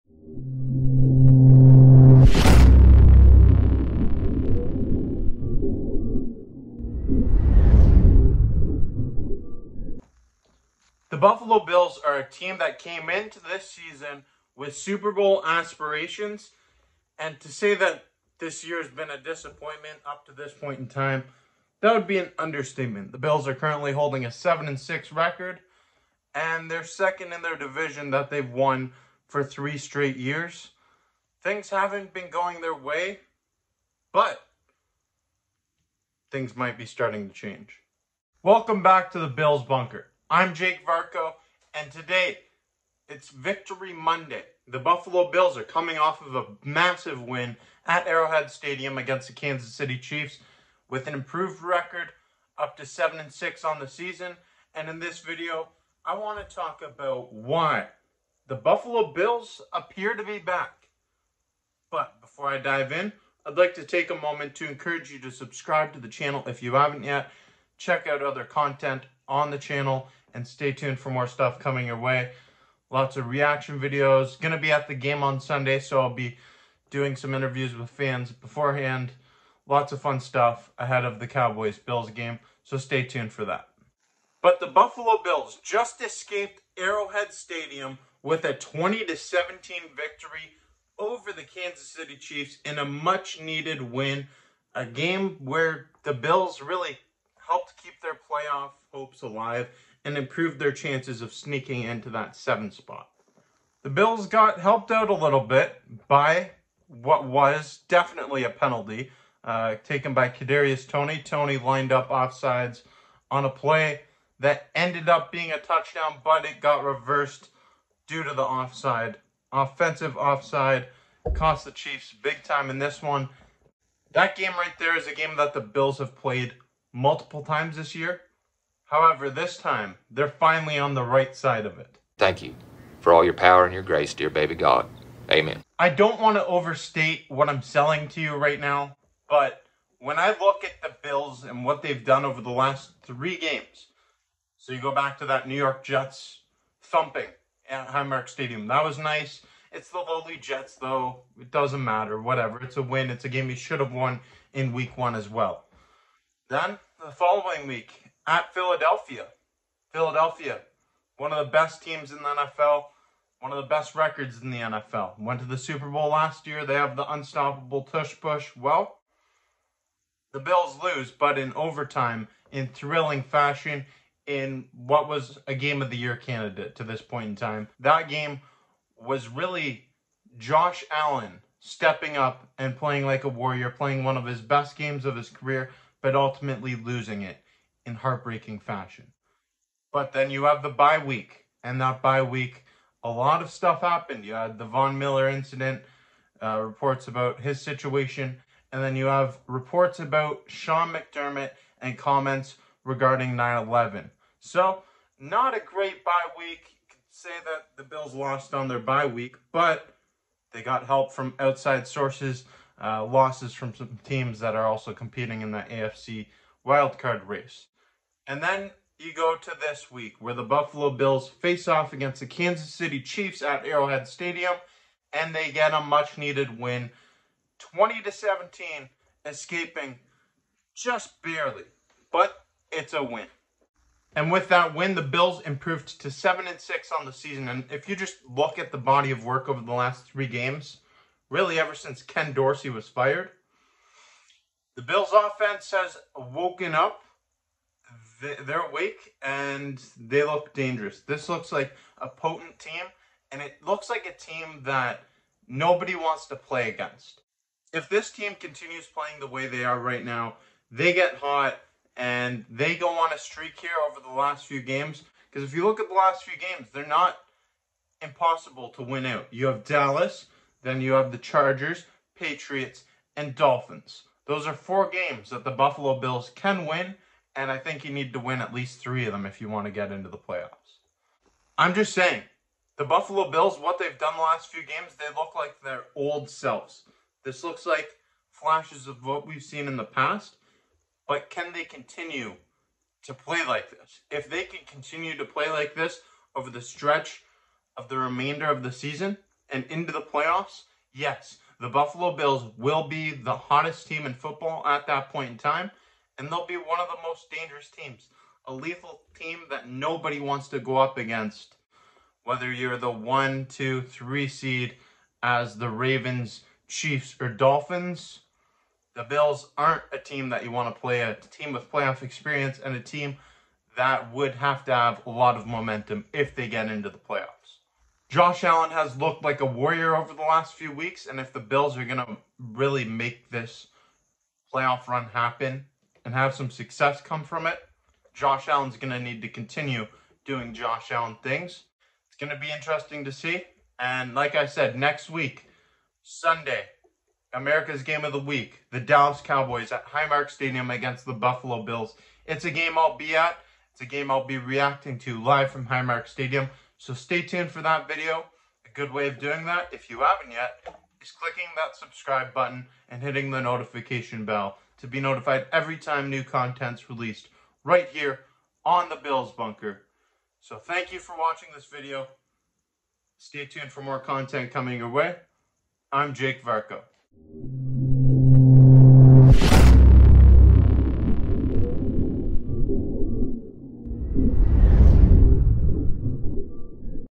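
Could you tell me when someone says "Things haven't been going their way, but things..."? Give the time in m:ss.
0:31.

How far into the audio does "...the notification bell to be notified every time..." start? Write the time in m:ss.
6:03.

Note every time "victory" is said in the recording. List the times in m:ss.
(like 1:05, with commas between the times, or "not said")
0:43, 1:29.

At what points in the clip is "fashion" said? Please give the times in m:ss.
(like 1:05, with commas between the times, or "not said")
2:53, 3:08.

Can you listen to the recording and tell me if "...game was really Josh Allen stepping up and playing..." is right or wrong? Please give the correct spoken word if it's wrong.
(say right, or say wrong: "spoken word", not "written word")
right.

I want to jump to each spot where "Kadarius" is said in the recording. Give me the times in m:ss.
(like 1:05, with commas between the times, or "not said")
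1:50.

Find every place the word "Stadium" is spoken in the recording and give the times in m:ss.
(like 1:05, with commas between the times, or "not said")
0:48, 1:27, 2:28, 3:44, 5:50, 5:56.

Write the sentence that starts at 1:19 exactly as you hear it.
Lots of fun stuff ahead of the Cowboys Bills game, so stay tuned for that.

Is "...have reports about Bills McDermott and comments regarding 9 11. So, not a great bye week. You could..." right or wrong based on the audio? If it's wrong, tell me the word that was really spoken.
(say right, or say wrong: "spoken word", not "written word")
wrong: "Sean", not "Bills".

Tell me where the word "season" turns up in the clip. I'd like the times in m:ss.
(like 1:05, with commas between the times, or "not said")
0:13, 0:53, 3:57, 4:58.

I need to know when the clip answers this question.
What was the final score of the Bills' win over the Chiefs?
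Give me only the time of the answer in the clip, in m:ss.
1:28.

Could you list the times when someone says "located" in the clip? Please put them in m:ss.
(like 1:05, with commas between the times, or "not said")
not said.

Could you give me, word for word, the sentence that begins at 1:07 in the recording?
Check out other content on the channel and stay tuned for more stuff coming your way.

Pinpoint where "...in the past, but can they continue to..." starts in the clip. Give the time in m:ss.
4:49.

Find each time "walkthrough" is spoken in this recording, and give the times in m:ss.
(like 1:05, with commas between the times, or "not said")
not said.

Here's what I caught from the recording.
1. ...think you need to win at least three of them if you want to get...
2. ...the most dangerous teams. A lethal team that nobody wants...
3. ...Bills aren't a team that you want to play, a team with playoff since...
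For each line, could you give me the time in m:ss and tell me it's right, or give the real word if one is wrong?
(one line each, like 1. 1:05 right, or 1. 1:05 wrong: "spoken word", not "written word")
1. 4:37 right
2. 5:06 right
3. 5:19 wrong: "experience", not "since".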